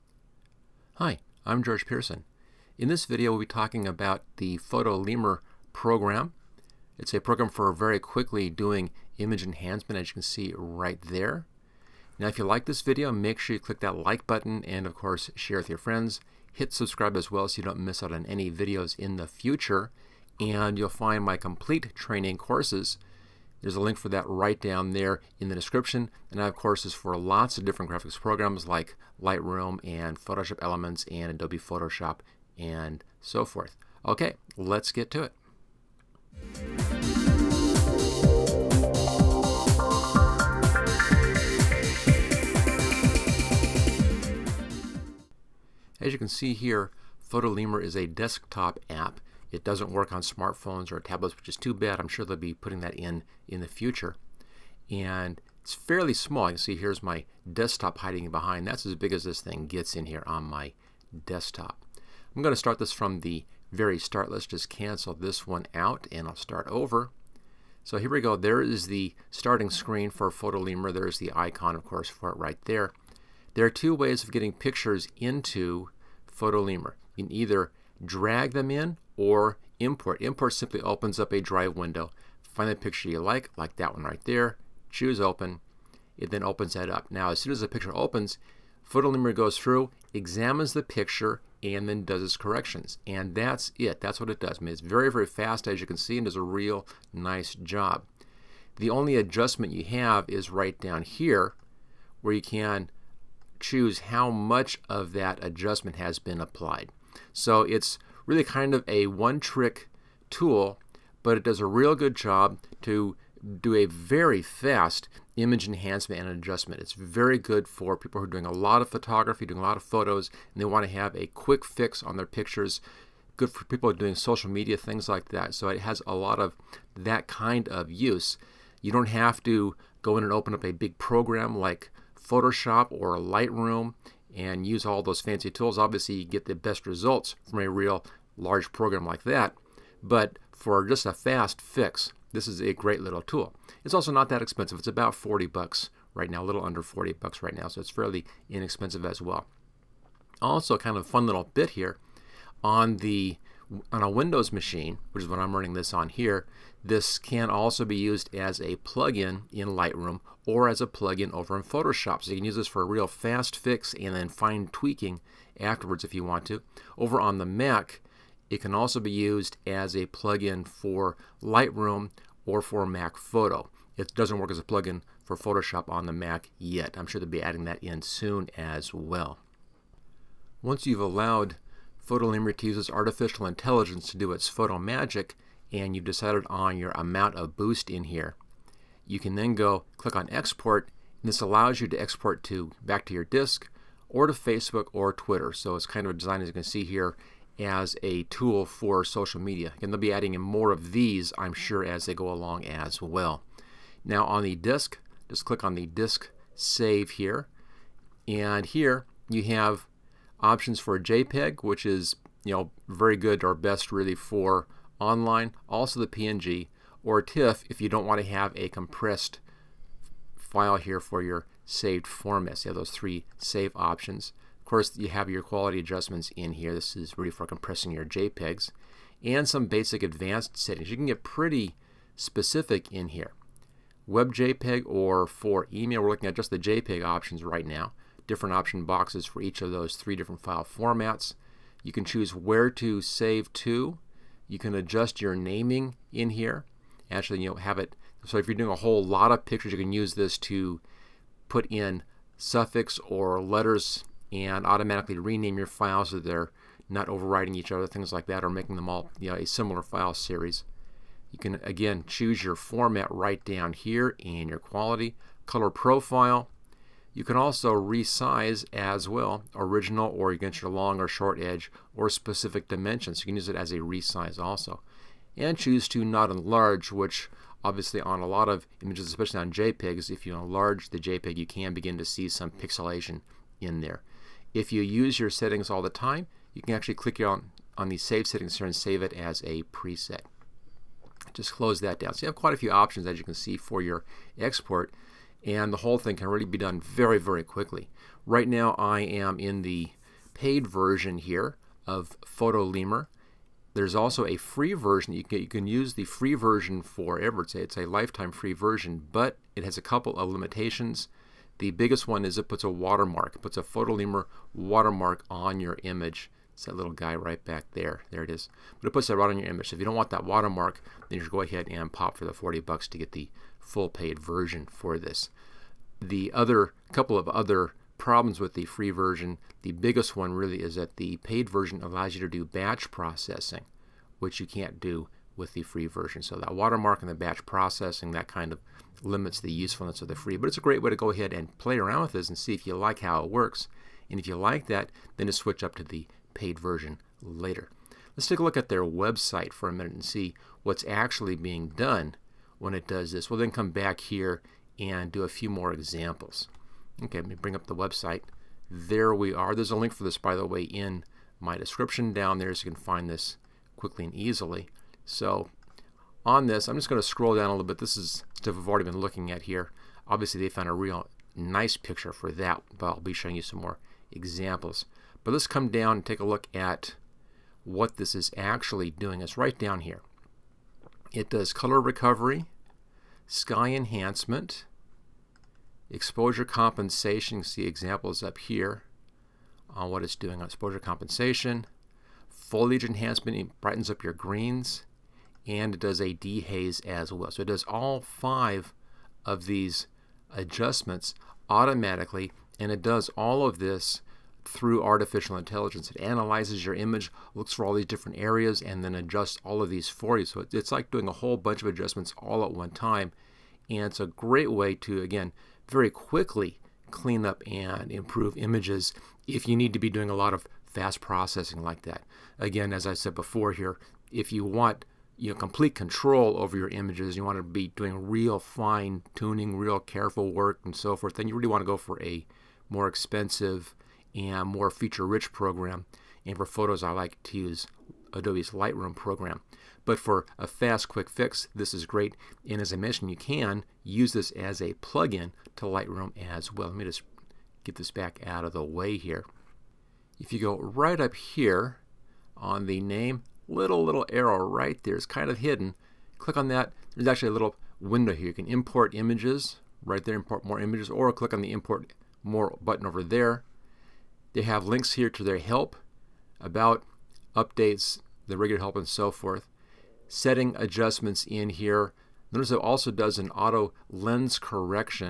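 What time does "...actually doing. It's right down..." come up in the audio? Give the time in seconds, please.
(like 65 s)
378 s.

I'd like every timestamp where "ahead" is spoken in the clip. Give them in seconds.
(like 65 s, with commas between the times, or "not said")
321 s, 341 s.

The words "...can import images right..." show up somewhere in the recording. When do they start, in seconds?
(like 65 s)
458 s.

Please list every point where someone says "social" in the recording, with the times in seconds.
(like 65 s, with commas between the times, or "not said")
124 s, 199 s.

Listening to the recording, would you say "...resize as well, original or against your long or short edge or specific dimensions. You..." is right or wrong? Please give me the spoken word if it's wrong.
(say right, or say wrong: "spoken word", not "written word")
right.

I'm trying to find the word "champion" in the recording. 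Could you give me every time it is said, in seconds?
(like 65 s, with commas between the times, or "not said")
not said.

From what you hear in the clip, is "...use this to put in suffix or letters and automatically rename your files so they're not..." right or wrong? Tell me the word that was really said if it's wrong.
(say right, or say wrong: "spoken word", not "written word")
right.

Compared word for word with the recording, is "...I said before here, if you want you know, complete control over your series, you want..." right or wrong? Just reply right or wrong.
wrong.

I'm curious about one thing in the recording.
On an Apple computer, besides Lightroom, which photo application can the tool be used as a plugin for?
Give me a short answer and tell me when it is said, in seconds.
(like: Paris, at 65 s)
Mac Photo, at 172 s.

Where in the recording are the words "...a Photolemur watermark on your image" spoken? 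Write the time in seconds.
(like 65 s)
313 s.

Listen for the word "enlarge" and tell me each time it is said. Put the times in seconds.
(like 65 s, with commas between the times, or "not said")
276 s, 280 s.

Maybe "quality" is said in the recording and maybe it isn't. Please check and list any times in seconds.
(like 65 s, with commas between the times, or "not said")
225 s, 264 s.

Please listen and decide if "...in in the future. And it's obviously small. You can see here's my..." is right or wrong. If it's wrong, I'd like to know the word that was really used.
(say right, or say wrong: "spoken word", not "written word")
wrong: "fairly", not "obviously".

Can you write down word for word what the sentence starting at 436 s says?
And for photos, I like to use Adobe's Lightroom program.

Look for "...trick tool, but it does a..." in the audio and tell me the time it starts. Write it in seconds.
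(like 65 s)
109 s.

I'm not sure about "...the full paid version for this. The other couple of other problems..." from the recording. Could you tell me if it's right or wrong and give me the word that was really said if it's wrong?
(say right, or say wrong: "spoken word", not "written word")
right.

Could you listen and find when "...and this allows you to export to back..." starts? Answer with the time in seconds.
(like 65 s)
191 s.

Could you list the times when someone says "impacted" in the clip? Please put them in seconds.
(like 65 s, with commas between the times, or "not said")
not said.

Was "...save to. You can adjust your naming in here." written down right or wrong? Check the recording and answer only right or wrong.
right.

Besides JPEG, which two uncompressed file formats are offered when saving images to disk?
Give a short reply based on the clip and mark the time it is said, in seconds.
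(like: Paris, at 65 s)
PNG or TIFF, at 216 s.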